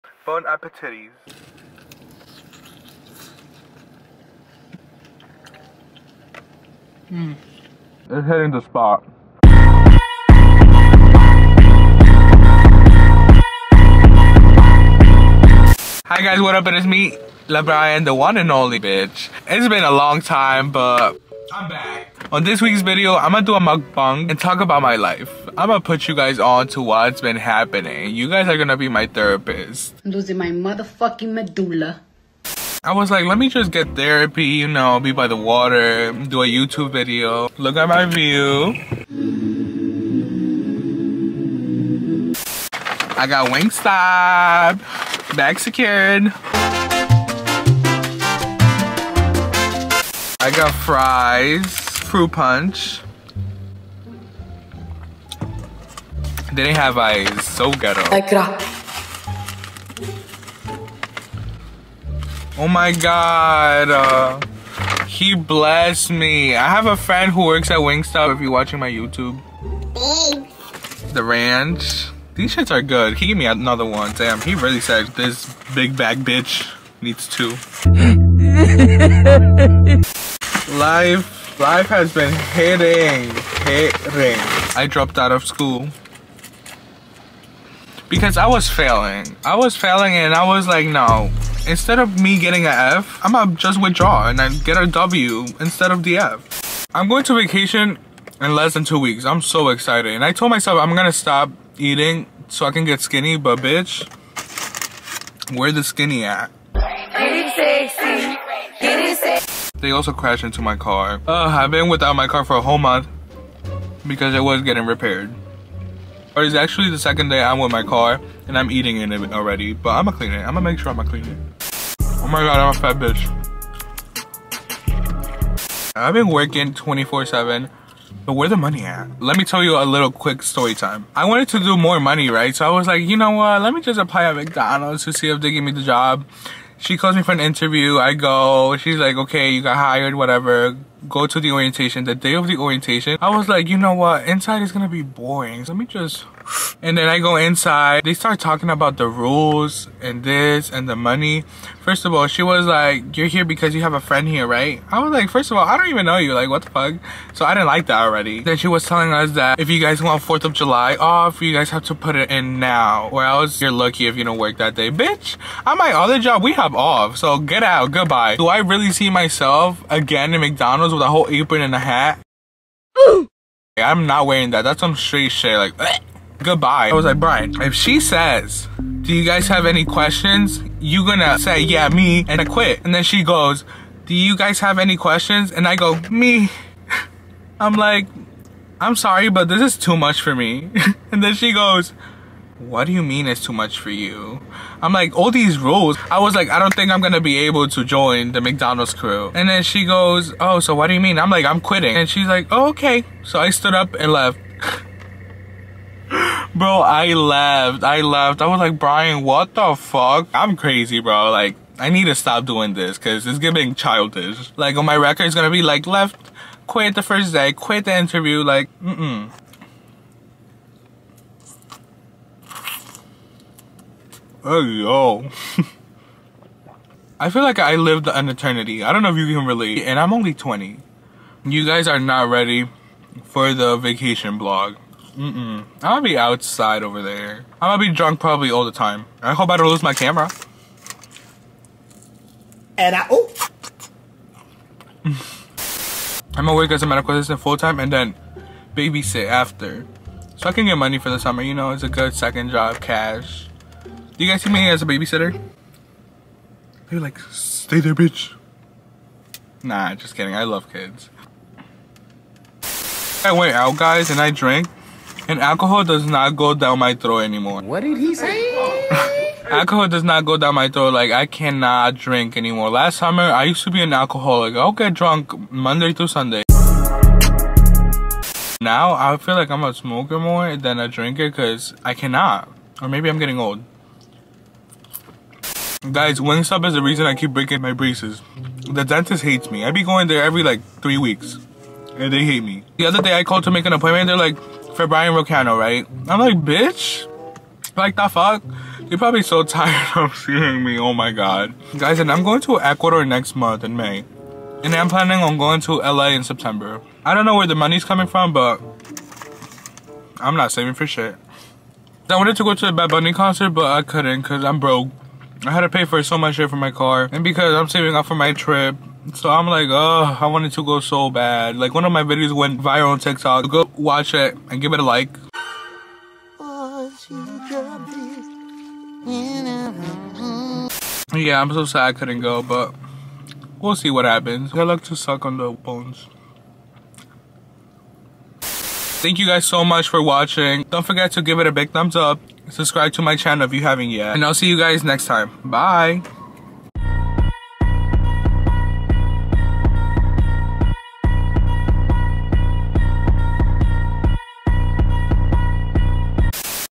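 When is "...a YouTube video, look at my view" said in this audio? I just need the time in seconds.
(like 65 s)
36 s.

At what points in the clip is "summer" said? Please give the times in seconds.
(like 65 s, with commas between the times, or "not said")
251 s, 272 s.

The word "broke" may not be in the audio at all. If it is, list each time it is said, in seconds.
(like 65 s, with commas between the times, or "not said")
314 s.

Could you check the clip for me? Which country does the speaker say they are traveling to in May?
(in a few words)
Ecuador.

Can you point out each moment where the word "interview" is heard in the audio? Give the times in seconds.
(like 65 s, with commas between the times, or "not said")
137 s, 217 s.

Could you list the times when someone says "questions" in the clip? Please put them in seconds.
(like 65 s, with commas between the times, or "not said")
179 s, 184 s.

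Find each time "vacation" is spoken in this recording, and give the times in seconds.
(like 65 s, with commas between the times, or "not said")
97 s, 233 s.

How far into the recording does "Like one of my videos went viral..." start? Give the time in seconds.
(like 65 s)
321 s.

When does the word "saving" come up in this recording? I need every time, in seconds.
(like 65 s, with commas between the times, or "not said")
310 s, 317 s.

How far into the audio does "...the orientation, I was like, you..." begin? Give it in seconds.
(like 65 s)
142 s.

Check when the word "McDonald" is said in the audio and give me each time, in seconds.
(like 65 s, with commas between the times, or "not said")
134 s, 170 s, 198 s.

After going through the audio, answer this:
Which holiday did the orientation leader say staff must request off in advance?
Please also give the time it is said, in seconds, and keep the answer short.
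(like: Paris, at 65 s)
4th of July, at 160 s.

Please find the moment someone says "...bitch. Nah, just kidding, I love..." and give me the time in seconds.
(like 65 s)
257 s.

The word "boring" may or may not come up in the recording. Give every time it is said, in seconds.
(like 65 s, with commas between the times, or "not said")
145 s.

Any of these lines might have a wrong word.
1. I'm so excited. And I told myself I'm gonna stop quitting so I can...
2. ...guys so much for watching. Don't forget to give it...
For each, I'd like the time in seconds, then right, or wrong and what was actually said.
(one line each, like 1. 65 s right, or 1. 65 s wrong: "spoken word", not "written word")
1. 99 s wrong: "eating", not "quitting"
2. 339 s right.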